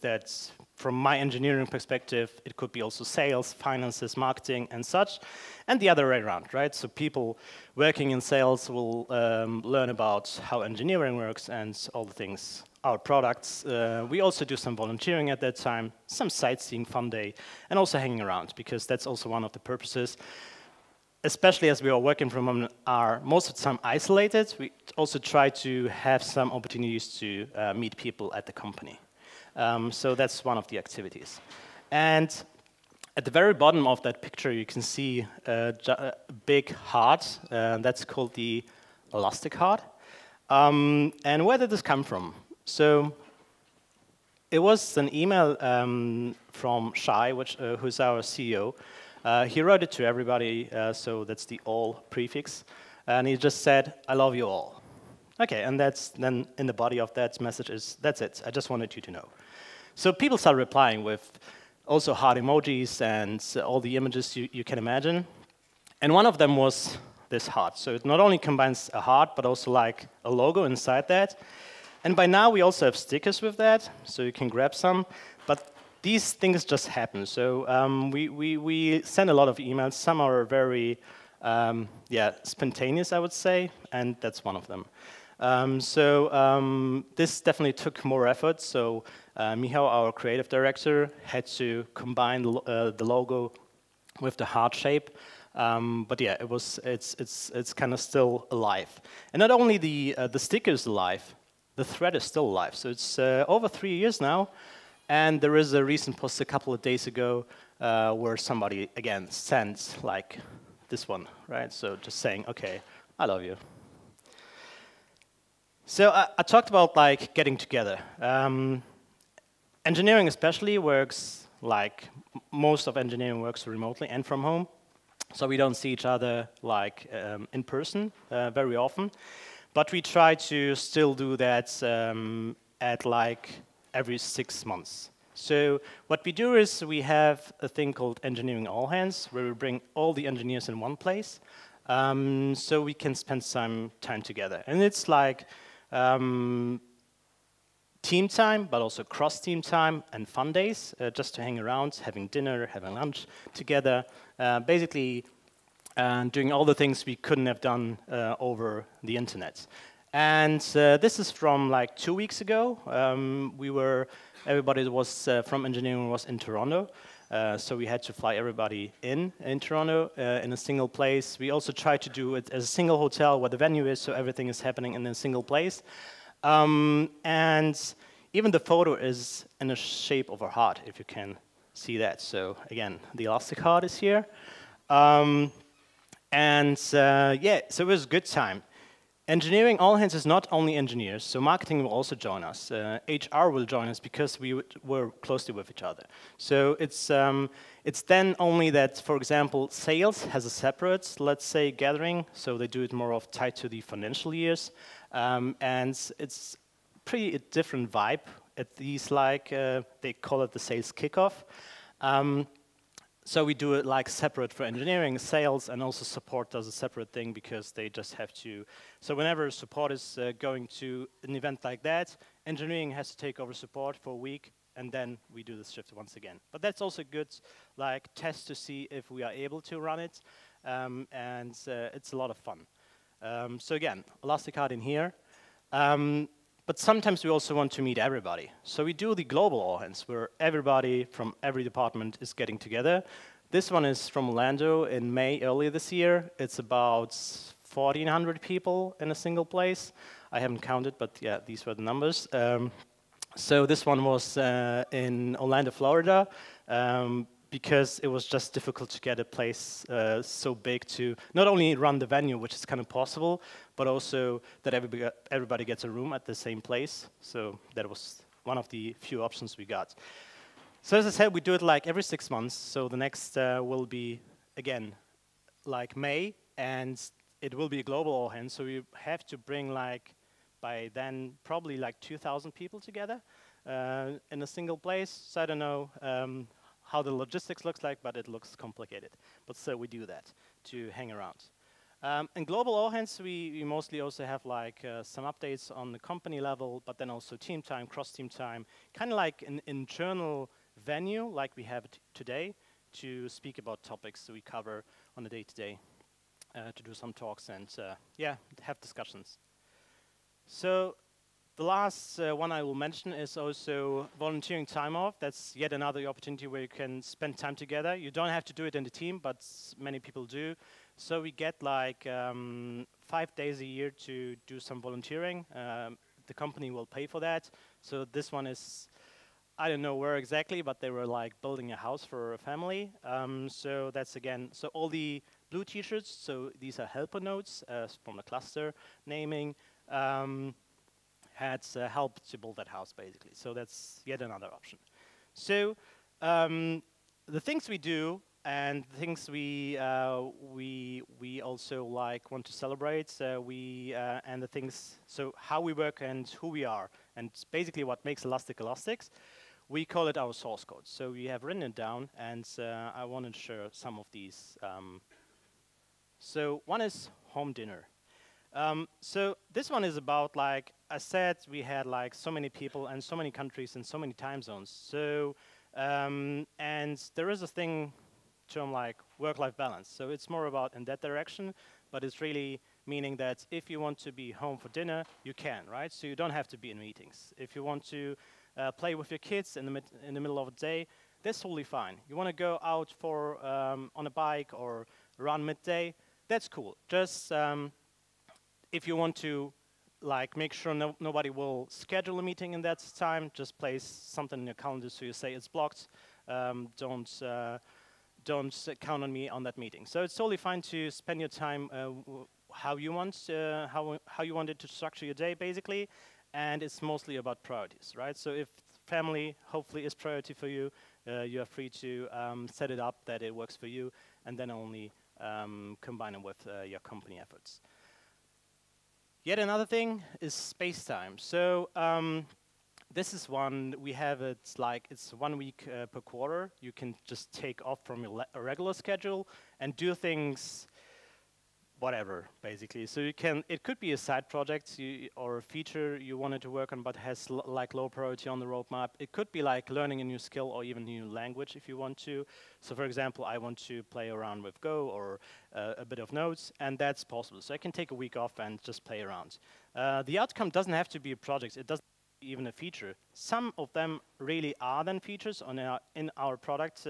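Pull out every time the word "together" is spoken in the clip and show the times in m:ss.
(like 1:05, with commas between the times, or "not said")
1:57, 2:24, 2:33, 4:02, 4:42, 5:17.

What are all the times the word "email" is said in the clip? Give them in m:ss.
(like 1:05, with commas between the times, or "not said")
0:45, 1:19.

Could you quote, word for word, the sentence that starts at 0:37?
Uh, that's called the elastic heart.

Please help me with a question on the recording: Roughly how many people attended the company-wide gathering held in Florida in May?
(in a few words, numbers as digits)
1,400.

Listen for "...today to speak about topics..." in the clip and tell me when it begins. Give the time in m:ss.
5:02.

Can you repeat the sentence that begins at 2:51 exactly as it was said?
We also tried to do it as a single hotel where the venue is, so everything is happening in a single place.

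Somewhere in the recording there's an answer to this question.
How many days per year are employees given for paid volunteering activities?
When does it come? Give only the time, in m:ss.
5:23.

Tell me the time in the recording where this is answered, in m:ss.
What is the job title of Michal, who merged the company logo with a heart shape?
1:30.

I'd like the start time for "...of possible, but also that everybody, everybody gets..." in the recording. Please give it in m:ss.
4:22.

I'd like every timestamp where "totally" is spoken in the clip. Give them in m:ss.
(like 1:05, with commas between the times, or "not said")
6:31, 6:50.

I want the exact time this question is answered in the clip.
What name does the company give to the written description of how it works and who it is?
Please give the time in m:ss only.
6:00.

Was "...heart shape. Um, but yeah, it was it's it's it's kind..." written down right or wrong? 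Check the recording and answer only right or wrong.
right.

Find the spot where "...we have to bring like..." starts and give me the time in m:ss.
4:38.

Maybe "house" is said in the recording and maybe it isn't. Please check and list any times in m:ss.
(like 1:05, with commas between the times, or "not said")
5:31, 5:42.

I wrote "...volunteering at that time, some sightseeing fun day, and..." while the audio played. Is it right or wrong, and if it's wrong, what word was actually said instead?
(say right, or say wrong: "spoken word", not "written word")
right.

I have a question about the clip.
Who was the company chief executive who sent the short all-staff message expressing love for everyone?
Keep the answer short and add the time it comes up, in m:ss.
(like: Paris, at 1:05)
Shay, at 0:46.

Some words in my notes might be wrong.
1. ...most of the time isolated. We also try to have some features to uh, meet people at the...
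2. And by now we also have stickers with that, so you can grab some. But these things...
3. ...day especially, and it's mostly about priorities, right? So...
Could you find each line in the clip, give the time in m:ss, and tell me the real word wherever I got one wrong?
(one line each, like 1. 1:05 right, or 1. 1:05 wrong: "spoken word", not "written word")
1. 0:23 wrong: "opportunities", not "features"
2. 1:12 right
3. 6:55 wrong: "basically", not "especially".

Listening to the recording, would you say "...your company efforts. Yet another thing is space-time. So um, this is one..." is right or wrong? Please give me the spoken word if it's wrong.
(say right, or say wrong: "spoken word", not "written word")
right.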